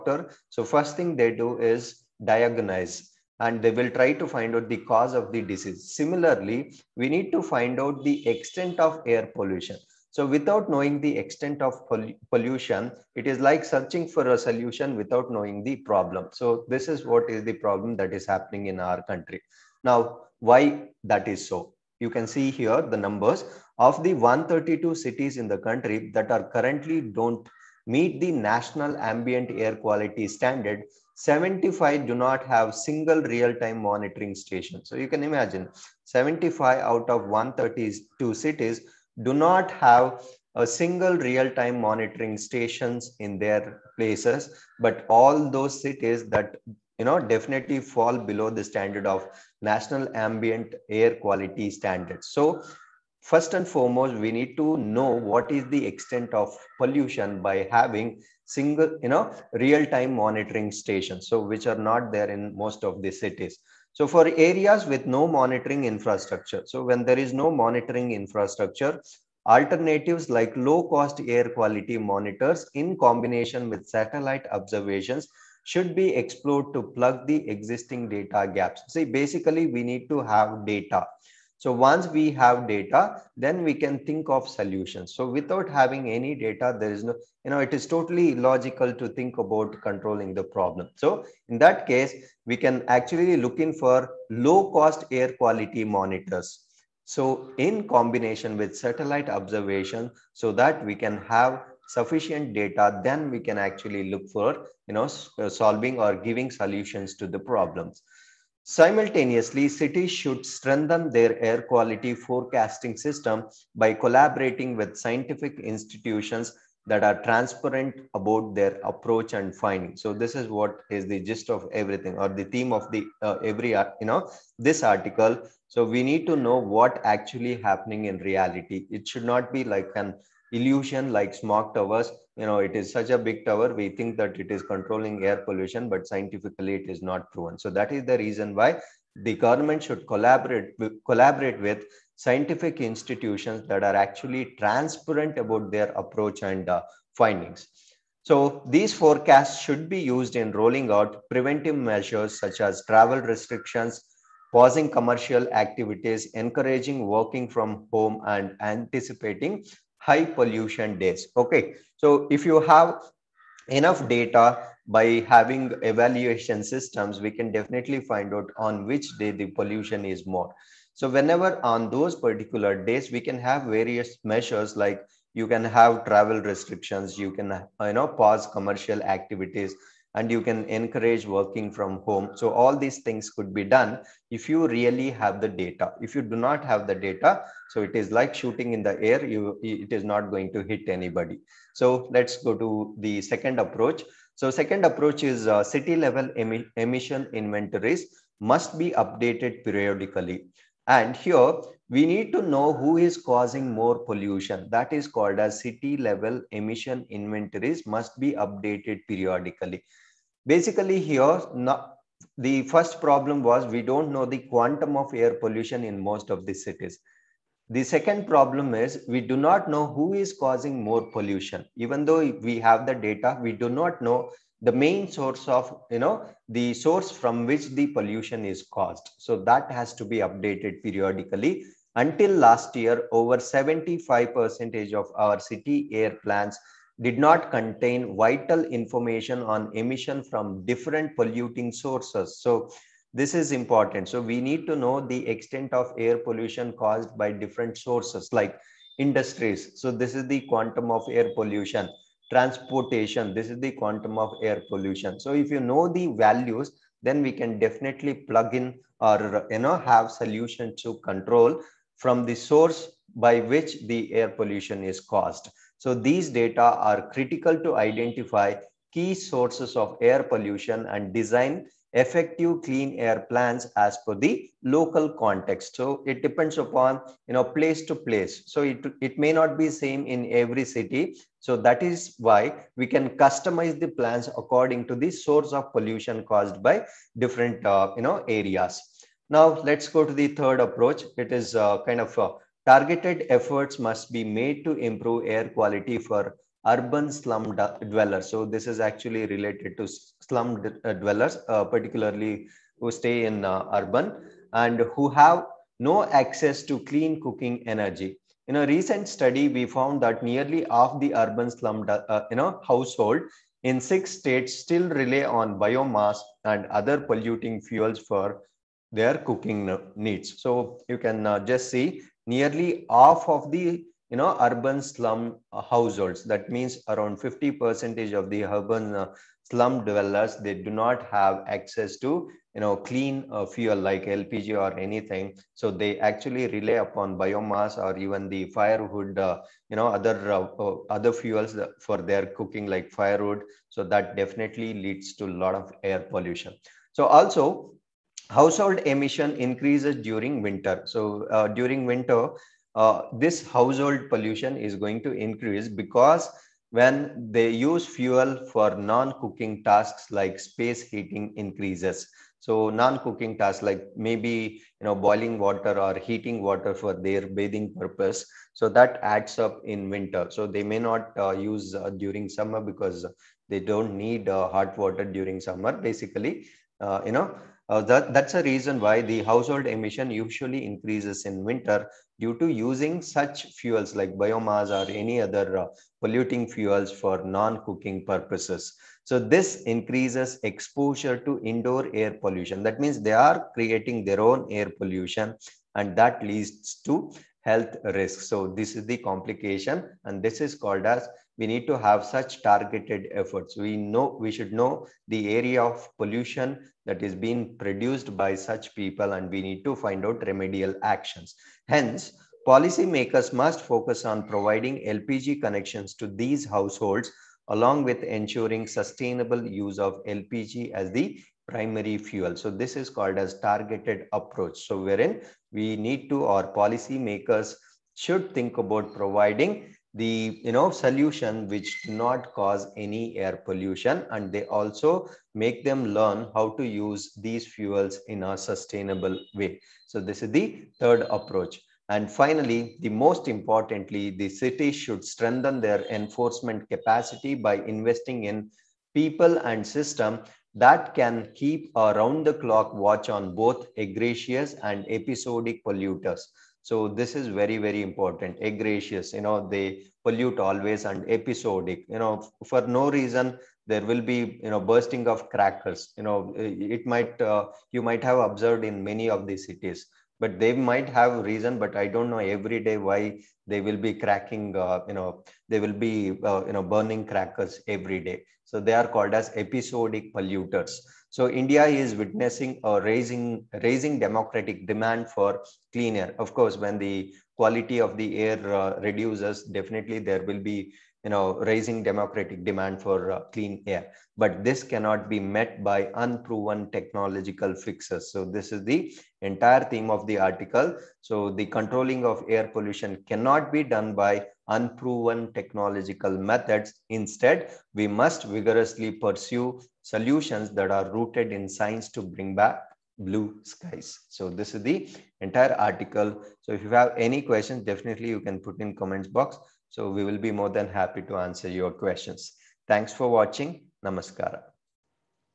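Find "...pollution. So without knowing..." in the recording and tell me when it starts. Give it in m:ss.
0:09.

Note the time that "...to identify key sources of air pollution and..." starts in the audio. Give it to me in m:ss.
4:27.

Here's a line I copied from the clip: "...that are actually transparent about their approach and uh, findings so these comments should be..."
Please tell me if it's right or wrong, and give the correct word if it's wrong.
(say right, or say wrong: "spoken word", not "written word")
wrong: "forecasts", not "comments".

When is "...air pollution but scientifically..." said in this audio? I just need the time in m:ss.
2:15.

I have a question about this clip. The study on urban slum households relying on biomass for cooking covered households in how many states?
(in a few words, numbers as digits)
6.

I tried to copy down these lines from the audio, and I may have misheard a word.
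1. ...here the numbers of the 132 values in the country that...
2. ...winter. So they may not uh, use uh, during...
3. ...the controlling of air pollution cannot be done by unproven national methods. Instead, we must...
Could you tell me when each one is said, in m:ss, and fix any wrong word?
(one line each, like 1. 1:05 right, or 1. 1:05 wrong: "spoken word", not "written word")
1. 0:22 wrong: "cities", not "values"
2. 6:09 right
3. 8:21 wrong: "technological", not "national".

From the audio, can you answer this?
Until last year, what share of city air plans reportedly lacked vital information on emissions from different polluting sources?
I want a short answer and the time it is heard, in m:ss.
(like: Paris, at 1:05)
Over 75%, at 3:53.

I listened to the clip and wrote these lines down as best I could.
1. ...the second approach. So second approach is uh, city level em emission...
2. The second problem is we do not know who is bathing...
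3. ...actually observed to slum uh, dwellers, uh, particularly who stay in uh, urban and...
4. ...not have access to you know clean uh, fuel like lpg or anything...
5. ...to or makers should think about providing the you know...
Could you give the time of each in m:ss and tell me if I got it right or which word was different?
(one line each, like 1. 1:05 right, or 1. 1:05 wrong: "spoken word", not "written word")
1. 3:12 right
2. 3:37 wrong: "causing", not "bathing"
3. 4:58 wrong: "related", not "observed"
4. 5:30 right
5. 7:06 right.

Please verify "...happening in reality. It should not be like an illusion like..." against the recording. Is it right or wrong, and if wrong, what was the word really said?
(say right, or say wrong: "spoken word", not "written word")
right.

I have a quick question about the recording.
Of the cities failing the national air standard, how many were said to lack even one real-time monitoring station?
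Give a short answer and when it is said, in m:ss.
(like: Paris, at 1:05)
75, at 0:31.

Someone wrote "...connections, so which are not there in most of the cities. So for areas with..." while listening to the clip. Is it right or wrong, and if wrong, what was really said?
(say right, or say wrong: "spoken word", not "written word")
wrong: "stations", not "connections".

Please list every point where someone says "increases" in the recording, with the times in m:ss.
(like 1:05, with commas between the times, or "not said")
5:49, 5:55, 6:01, 6:20, 6:29.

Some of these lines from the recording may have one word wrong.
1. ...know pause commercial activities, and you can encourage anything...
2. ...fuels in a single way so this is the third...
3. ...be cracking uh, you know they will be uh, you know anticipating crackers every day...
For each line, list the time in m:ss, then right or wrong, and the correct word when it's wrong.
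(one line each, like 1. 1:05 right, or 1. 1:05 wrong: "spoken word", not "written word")
1. 2:57 wrong: "working", not "anything"
2. 7:17 wrong: "sustainable", not "single"
3. 7:53 wrong: "burning", not "anticipating".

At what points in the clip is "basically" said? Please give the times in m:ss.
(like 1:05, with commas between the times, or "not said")
1:19, 3:30, 6:15.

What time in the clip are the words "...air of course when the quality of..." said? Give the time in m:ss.
8:05.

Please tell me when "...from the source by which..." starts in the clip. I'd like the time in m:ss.
4:21.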